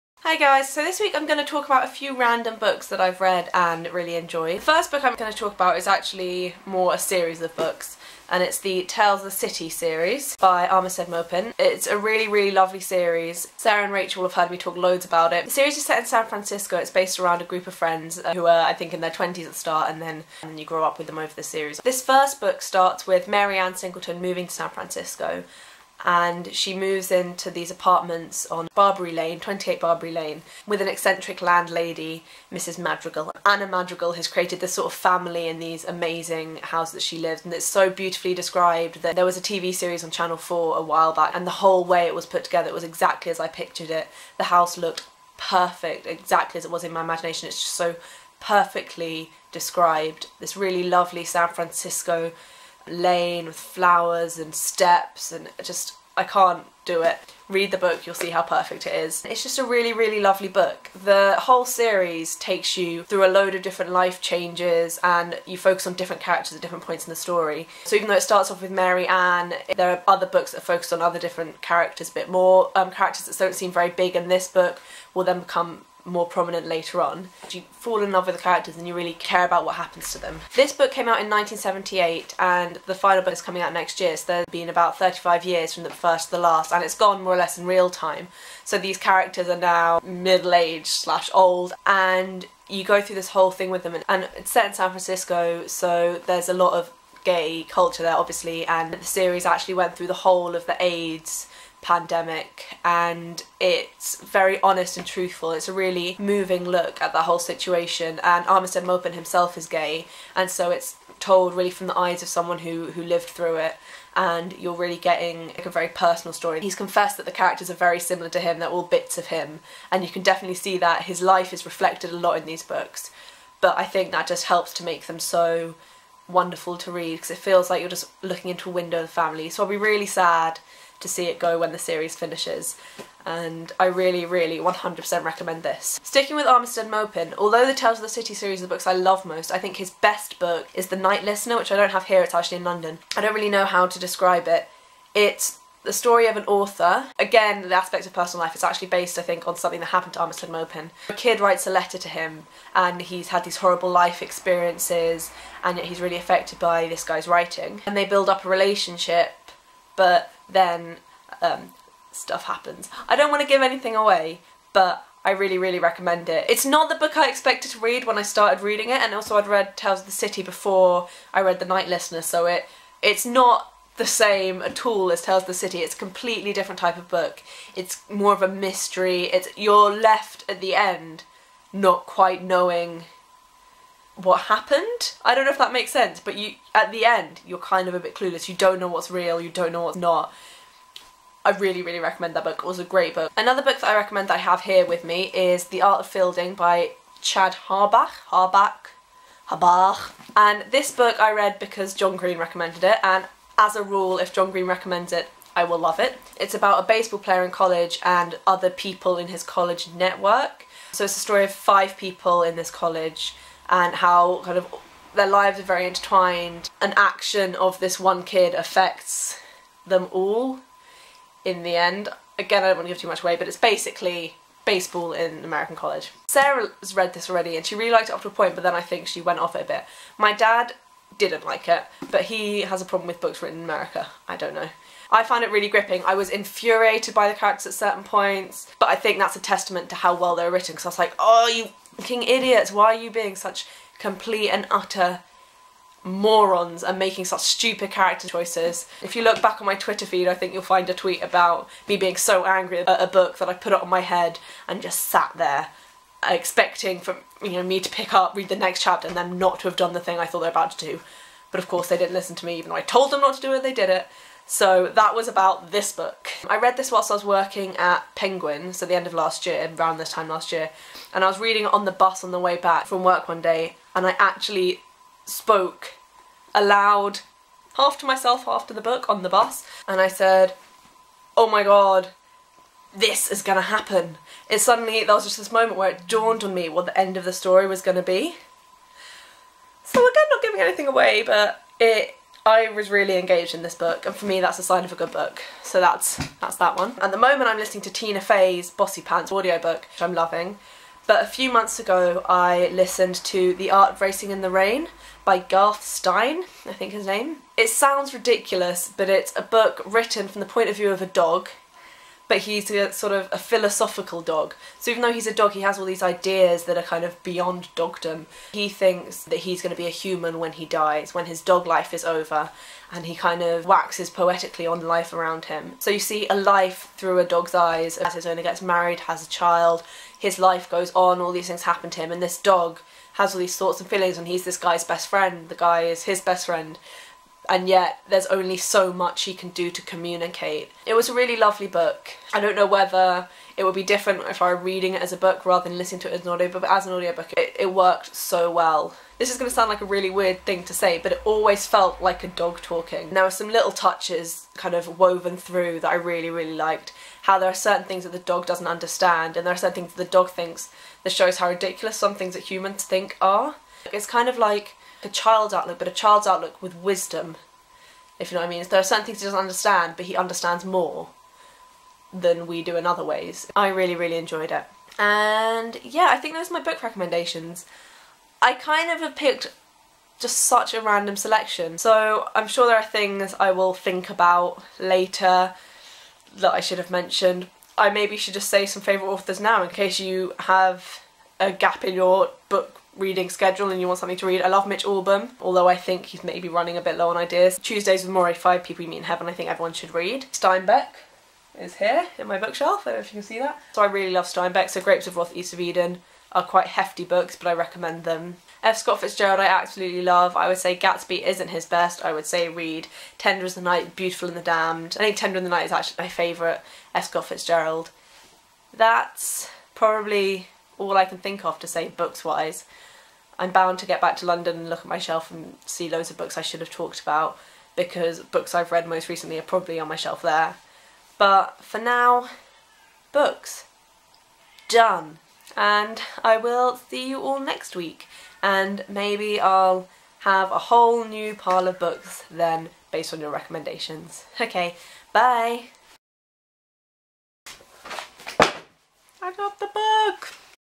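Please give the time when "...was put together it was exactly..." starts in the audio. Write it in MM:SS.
00:42.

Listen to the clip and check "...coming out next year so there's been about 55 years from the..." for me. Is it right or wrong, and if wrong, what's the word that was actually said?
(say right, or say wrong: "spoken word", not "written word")
wrong: "35", not "55".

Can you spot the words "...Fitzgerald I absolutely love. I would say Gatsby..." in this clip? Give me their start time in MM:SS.
06:49.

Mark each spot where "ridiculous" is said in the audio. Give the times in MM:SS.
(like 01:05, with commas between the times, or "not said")
05:08, 06:01.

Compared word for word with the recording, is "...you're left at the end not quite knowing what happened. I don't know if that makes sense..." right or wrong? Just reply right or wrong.
right.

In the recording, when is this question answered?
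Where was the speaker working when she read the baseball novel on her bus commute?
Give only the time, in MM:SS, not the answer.
04:28.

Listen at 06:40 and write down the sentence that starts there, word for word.
Steinbeck is here in my bookshelf, I don't know if you can see that.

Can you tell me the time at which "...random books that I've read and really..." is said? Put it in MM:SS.
00:02.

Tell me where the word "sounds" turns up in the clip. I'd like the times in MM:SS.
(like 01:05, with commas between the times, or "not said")
05:07, 05:49.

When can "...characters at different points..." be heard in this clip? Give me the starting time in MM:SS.
01:06.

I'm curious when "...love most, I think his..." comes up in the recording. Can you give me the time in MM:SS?
02:18.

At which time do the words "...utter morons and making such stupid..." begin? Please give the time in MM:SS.
04:04.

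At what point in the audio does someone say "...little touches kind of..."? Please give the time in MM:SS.
05:53.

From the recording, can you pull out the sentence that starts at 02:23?
I don't really know how to describe it.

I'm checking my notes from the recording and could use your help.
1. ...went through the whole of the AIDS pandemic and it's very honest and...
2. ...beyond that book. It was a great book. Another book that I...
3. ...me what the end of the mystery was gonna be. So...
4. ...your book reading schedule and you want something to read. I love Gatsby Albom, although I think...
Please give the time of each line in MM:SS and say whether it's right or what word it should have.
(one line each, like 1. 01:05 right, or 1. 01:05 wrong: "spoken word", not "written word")
1. 01:39 right
2. 03:11 wrong: "recommend", not "beyond"
3. 04:46 wrong: "story", not "mystery"
4. 06:31 wrong: "Mitch", not "Gatsby".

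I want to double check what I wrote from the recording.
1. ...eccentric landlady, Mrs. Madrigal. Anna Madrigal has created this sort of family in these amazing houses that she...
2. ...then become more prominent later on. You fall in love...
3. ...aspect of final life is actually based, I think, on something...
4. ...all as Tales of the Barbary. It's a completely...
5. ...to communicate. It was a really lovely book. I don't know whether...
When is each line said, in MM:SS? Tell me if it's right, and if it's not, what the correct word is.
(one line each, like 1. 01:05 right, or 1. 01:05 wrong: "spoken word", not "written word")
1. 00:30 right
2. 01:15 right
3. 02:27 wrong: "personal", not "final"
4. 02:54 wrong: "City", not "Barbary"
5. 05:39 right.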